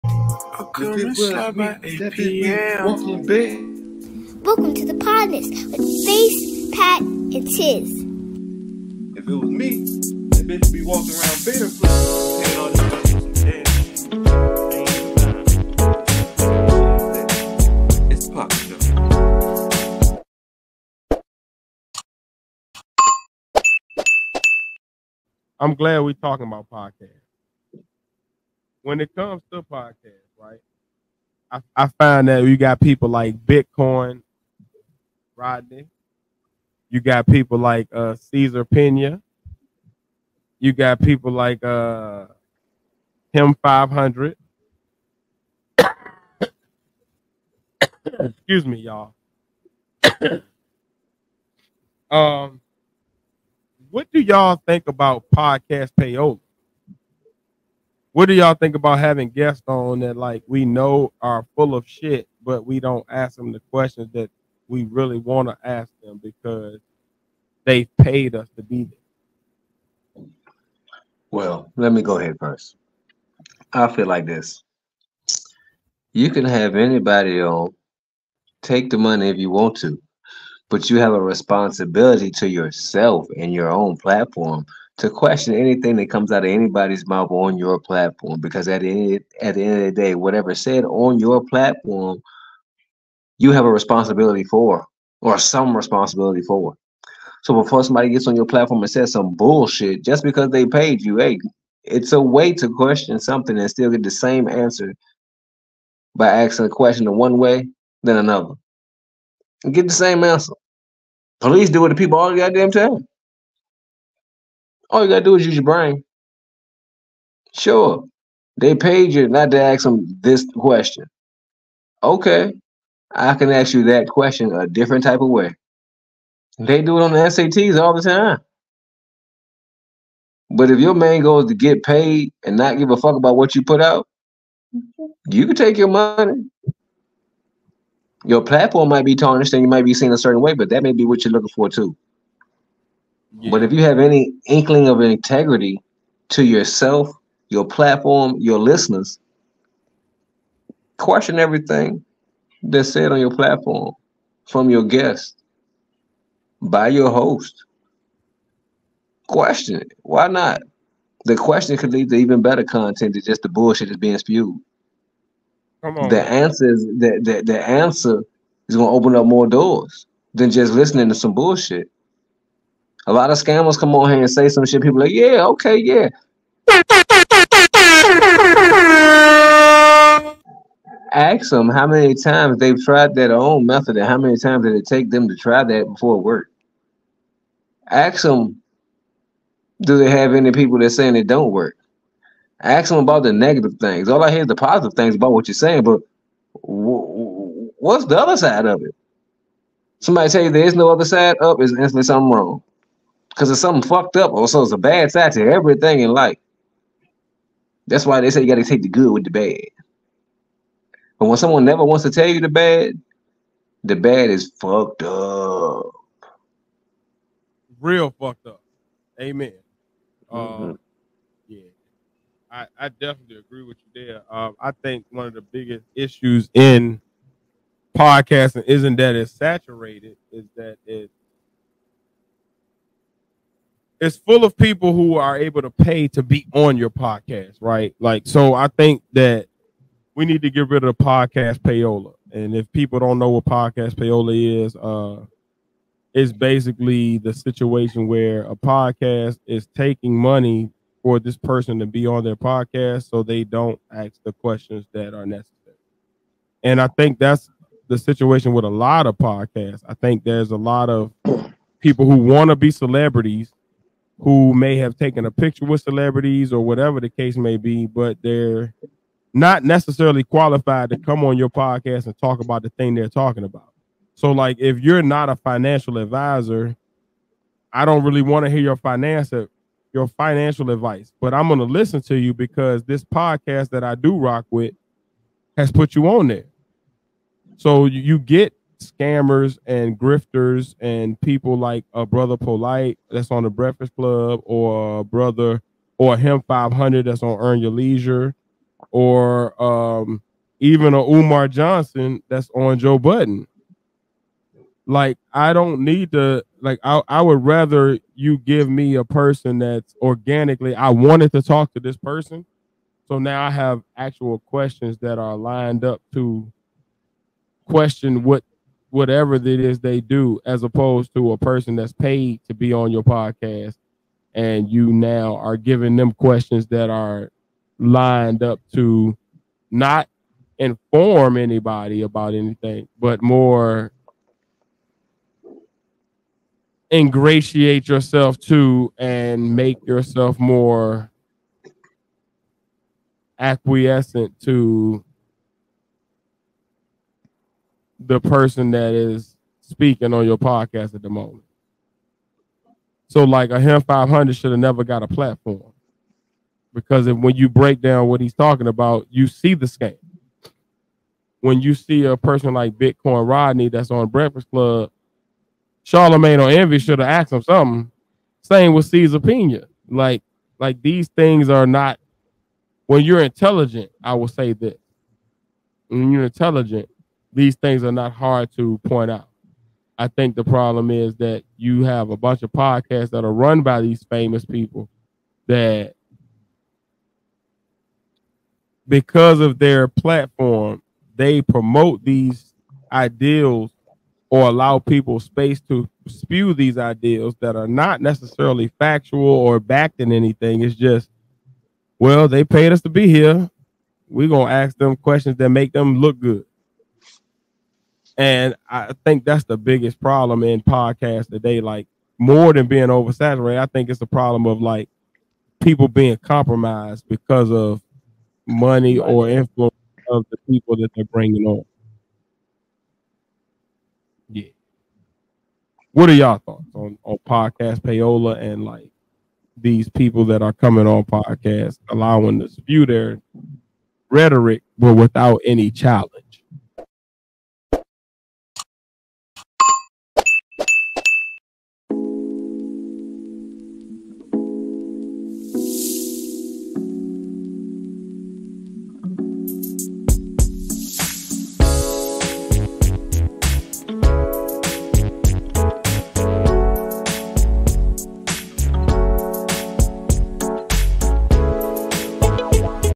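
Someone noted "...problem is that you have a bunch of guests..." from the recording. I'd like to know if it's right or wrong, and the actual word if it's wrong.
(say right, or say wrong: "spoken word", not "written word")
wrong: "podcasts", not "guests".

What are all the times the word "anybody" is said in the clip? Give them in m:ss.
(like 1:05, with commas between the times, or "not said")
1:16, 1:26, 5:31.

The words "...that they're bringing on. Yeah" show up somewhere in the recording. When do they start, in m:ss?
7:00.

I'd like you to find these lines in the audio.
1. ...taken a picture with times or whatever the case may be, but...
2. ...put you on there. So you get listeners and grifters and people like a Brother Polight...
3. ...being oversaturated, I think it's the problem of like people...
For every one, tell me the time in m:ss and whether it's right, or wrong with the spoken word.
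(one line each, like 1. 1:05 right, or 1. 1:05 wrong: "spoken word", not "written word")
1. 4:24 wrong: "celebrities", not "times"
2. 4:45 wrong: "scammers", not "listeners"
3. 6:52 right.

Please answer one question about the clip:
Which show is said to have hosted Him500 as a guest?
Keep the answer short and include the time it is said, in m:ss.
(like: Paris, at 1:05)
Earn Your Leisure, at 4:57.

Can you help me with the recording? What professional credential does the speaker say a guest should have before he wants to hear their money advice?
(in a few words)
financial advisor.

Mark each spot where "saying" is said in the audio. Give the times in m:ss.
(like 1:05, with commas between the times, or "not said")
3:10, 3:15.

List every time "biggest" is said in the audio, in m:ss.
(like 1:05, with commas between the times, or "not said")
3:45, 6:49.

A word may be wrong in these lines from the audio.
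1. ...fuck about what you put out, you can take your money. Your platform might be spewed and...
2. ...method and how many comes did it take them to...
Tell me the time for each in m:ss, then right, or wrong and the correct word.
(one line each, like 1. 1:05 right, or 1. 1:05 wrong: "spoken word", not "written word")
1. 2:12 wrong: "tarnished", not "spewed"
2. 3:03 wrong: "times", not "comes".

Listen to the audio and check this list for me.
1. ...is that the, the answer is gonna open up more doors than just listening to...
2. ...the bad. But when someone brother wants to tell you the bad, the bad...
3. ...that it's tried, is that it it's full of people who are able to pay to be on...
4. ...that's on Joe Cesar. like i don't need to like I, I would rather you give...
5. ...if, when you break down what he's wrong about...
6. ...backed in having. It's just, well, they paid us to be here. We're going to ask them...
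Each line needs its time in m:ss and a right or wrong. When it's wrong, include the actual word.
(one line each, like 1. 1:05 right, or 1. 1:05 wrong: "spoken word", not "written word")
1. 2:46 right
2. 3:29 wrong: "never", not "brother"
3. 3:48 wrong: "saturated", not "tried"
4. 5:02 wrong: "Budden", not "Cesar"
5. 5:57 wrong: "talking", not "wrong"
6. 6:39 wrong: "anything", not "having".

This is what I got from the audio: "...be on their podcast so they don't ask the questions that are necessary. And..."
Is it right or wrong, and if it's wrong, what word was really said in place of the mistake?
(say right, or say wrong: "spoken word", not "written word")
right.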